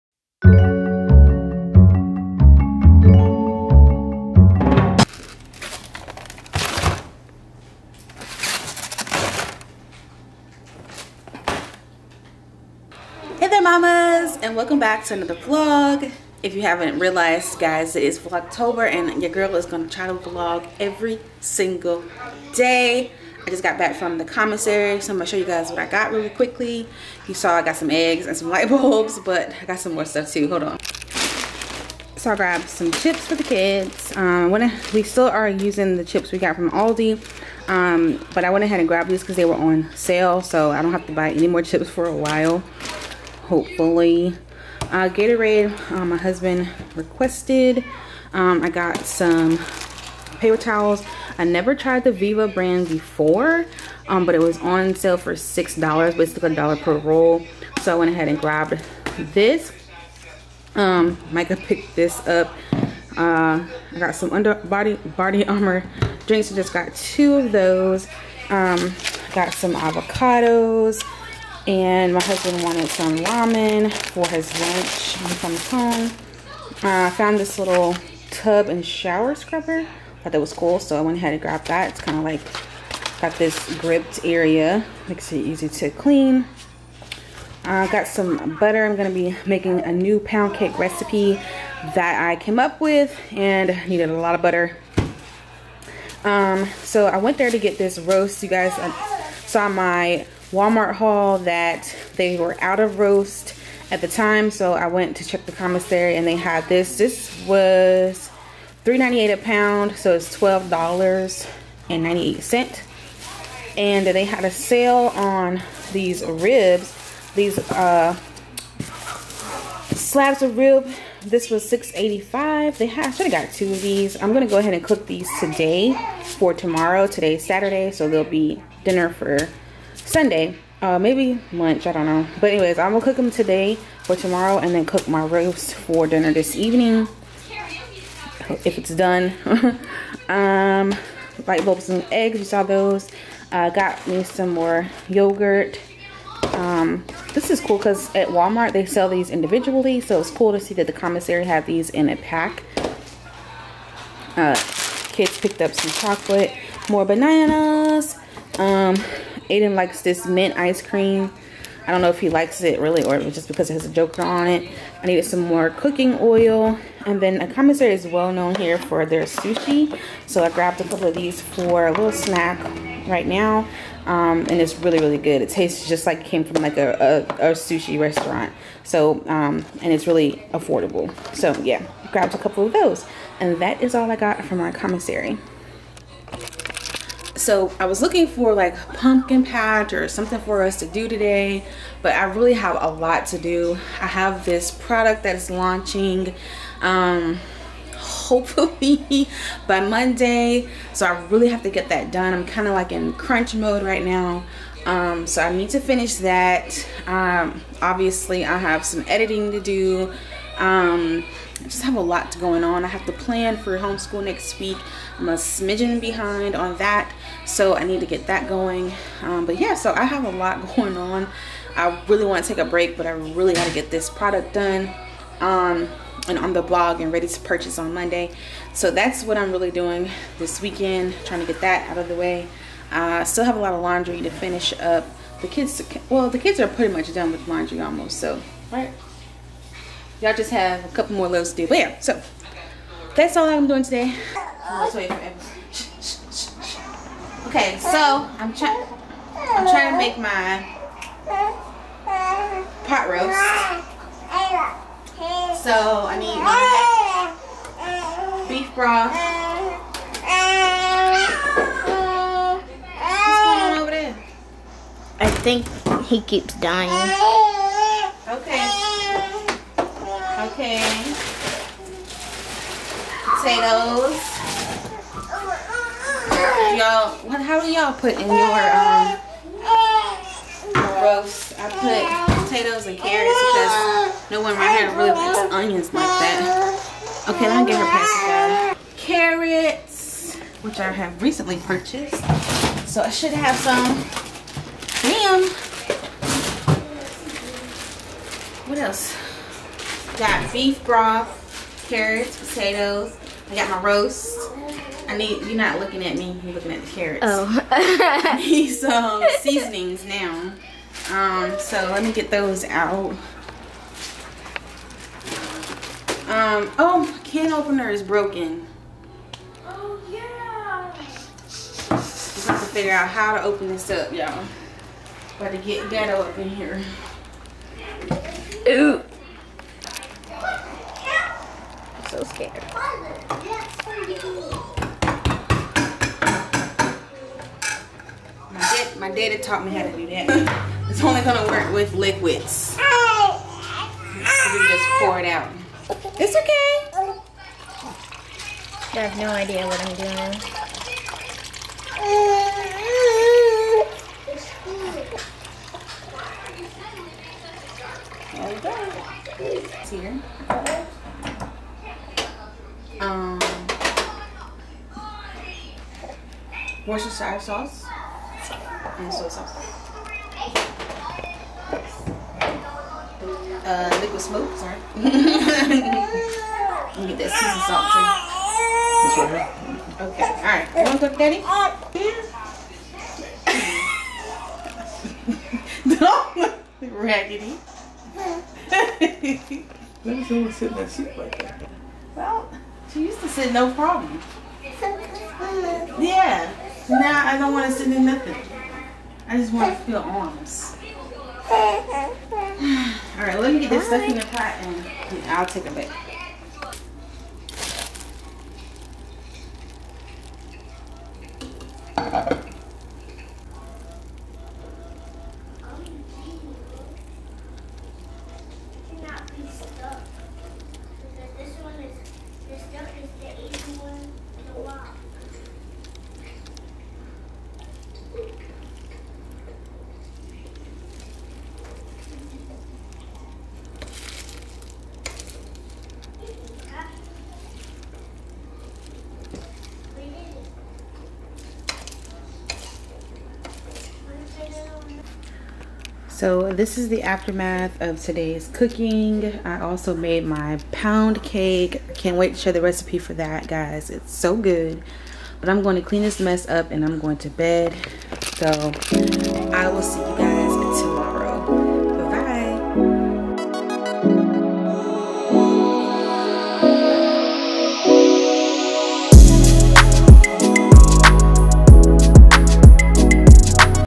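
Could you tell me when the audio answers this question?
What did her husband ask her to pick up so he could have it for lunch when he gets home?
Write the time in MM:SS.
01:13.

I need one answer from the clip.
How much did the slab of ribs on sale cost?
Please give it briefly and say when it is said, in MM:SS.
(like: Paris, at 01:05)
$6.85, at 02:01.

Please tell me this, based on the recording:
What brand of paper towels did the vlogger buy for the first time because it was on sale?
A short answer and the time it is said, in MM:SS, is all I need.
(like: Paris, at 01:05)
Viva, at 00:52.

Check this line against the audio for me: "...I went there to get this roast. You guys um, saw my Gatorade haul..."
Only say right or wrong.
wrong.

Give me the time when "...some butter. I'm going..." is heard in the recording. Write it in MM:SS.
01:28.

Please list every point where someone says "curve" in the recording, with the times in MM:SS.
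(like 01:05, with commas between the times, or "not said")
not said.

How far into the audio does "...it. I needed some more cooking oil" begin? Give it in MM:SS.
02:44.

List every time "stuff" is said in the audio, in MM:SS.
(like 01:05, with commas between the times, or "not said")
00:30, 06:43.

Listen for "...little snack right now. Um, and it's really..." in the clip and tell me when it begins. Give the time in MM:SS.
02:51.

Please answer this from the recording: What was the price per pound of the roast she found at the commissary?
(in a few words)
$3.98.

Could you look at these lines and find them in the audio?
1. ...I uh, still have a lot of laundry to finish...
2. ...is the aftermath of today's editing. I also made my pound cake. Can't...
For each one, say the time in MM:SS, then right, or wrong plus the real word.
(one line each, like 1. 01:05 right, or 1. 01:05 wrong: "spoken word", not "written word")
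1. 03:52 right
2. 07:26 wrong: "cooking", not "editing".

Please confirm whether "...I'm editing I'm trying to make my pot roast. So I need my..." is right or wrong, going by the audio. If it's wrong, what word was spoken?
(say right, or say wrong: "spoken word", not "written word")
wrong: "trying", not "editing".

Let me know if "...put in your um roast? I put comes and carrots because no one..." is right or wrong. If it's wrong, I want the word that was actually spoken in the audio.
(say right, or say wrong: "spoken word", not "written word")
wrong: "potatoes", not "comes".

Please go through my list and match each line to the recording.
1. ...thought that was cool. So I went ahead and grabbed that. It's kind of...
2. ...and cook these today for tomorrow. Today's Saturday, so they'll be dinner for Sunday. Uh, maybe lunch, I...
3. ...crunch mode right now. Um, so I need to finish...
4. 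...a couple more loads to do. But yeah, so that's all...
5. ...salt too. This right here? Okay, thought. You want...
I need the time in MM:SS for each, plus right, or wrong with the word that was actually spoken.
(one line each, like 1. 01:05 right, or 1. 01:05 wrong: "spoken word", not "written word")
1. 01:20 right
2. 02:04 right
3. 03:23 right
4. 04:00 right
5. 06:18 wrong: "alright", not "thought".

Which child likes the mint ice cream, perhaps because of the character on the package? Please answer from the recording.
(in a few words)
Aiden.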